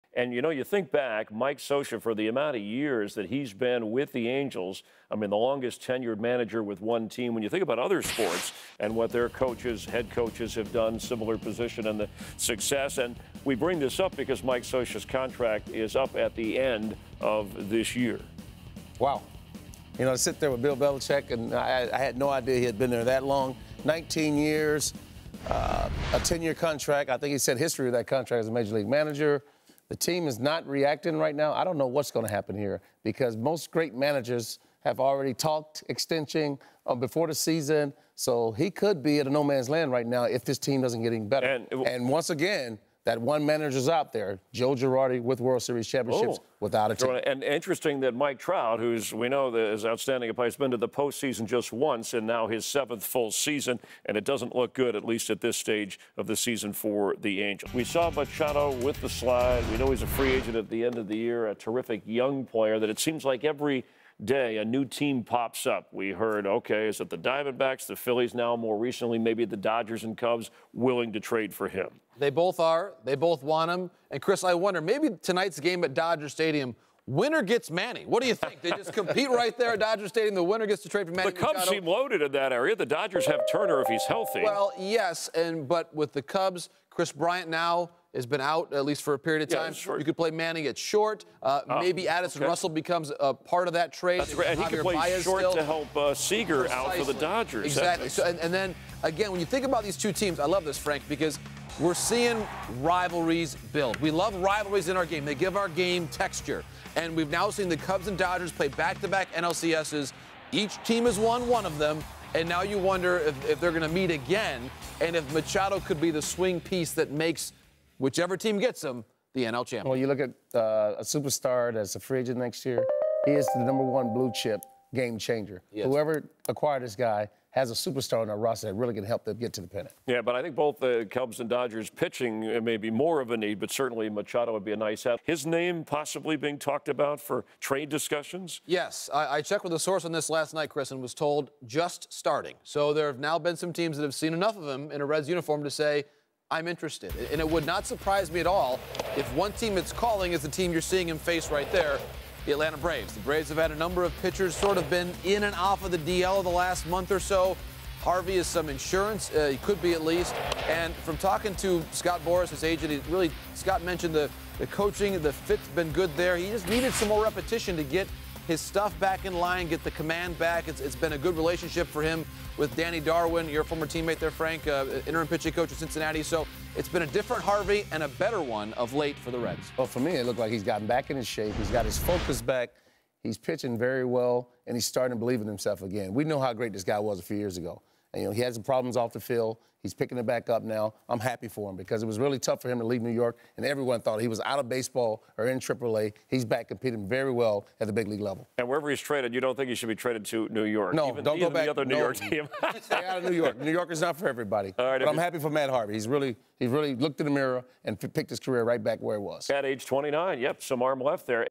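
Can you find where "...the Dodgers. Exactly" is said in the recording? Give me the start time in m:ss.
1:37.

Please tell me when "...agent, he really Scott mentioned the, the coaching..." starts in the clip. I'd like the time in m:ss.
2:42.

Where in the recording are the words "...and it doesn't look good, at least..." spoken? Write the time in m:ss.
0:54.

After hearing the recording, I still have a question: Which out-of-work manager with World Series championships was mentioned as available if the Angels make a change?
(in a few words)
Joe Girardi.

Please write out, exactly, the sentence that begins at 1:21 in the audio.
The Cubs seem loaded in that area.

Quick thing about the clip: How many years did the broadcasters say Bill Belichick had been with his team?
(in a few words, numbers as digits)
19.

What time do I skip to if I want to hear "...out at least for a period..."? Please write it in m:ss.
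1:28.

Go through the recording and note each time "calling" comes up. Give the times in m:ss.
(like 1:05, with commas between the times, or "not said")
2:29.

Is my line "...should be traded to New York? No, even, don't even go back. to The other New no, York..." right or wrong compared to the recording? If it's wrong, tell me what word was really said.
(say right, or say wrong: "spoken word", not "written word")
right.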